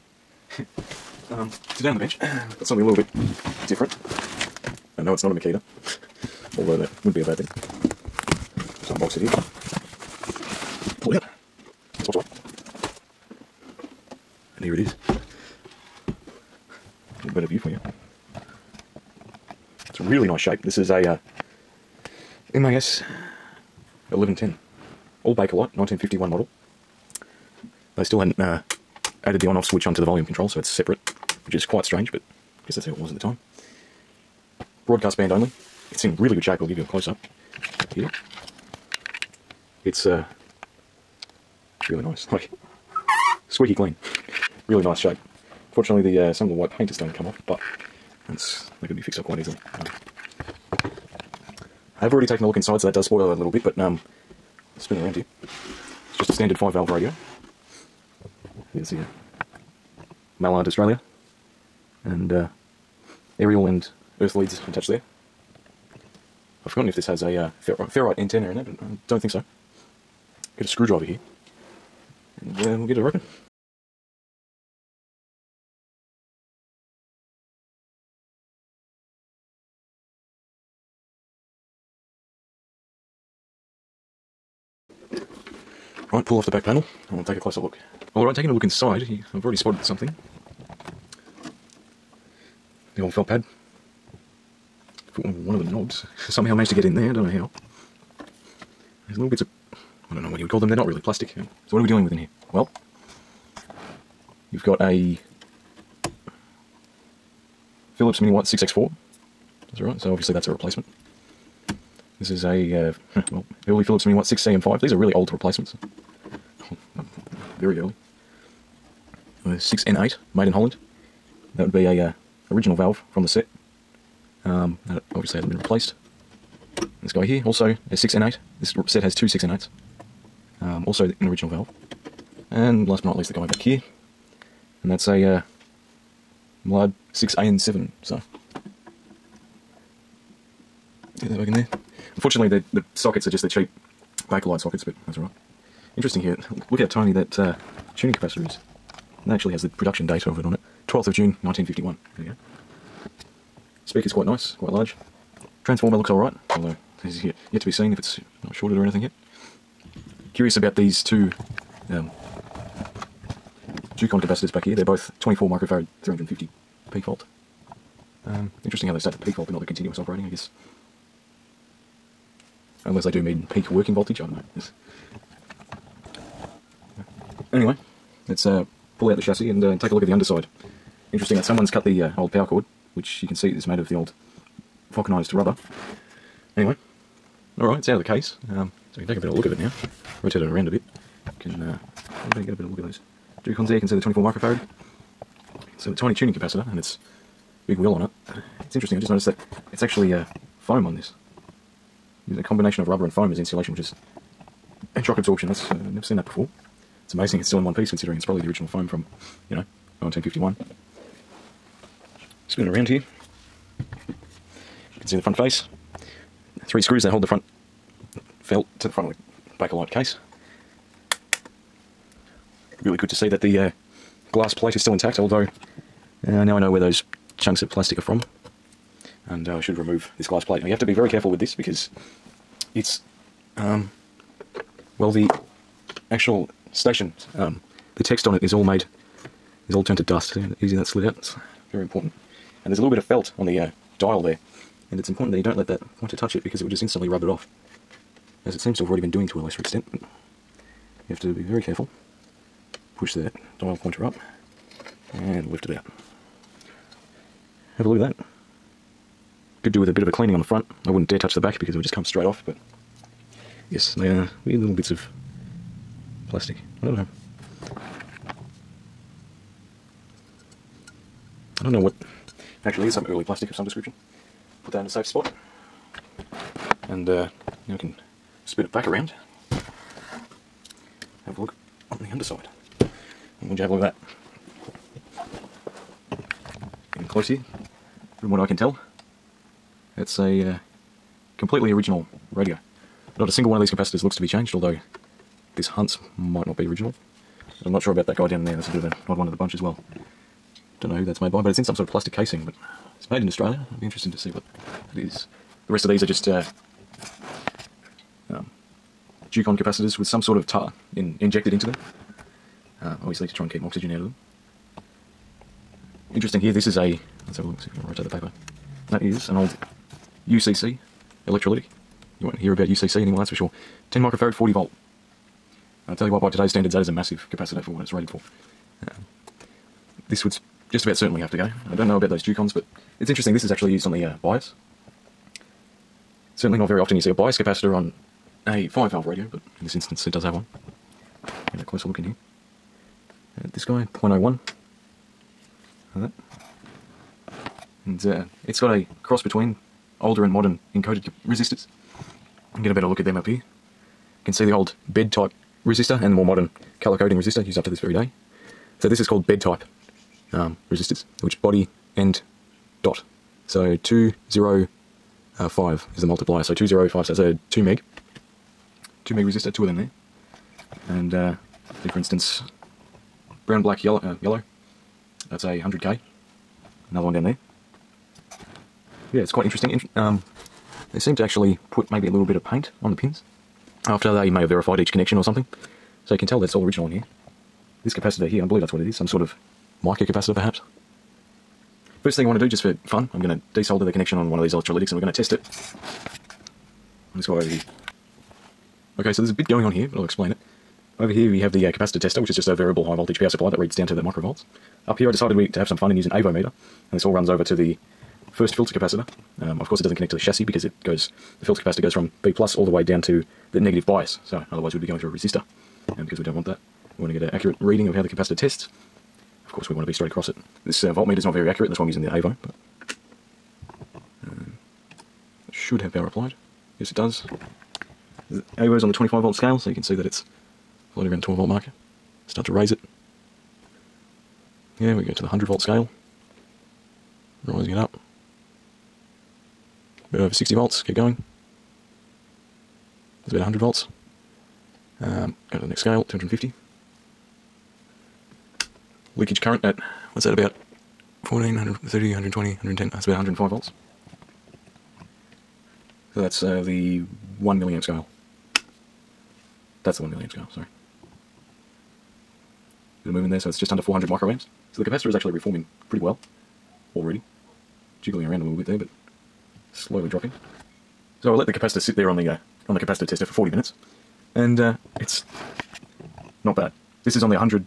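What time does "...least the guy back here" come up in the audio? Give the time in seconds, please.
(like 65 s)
133 s.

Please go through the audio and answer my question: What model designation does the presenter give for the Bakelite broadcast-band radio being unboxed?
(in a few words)
MAS 1110.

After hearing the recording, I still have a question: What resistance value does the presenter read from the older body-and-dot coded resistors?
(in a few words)
2 meg.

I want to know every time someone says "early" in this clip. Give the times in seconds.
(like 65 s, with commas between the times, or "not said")
113 s, 117 s, 273 s.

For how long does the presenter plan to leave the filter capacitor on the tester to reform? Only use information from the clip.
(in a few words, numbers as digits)
40 minutes.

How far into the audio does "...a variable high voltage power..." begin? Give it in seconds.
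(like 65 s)
402 s.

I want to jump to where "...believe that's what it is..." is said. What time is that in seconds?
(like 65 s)
388 s.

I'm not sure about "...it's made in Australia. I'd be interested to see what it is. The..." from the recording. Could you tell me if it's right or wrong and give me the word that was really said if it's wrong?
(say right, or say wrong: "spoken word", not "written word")
right.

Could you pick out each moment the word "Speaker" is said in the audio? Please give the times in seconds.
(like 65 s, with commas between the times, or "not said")
153 s.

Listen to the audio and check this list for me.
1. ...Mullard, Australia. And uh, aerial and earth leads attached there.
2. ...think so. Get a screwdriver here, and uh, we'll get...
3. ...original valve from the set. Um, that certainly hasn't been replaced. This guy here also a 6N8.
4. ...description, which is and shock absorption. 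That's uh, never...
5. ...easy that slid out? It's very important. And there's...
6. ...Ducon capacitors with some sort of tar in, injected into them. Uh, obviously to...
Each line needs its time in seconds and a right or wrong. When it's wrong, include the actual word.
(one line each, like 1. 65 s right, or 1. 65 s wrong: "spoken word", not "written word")
1. 60 s right
2. 69 s right
3. 122 s wrong: "obviously", not "certainly"
4. 203 s wrong: "insulation", not "description"
5. 240 s right
6. 309 s right.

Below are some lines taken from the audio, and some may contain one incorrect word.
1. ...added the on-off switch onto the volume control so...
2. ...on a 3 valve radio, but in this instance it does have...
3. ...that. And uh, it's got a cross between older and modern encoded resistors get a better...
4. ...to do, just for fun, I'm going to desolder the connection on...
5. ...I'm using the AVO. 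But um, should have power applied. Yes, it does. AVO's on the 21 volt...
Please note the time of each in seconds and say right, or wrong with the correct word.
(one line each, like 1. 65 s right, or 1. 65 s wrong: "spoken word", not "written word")
1. 29 s right
2. 337 s wrong: "5", not "3"
3. 347 s right
4. 392 s right
5. 421 s wrong: "25", not "21".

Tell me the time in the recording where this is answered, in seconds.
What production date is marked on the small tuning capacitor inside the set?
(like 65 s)
150 s.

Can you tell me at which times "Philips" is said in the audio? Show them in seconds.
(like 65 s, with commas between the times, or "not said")
107 s, 113 s.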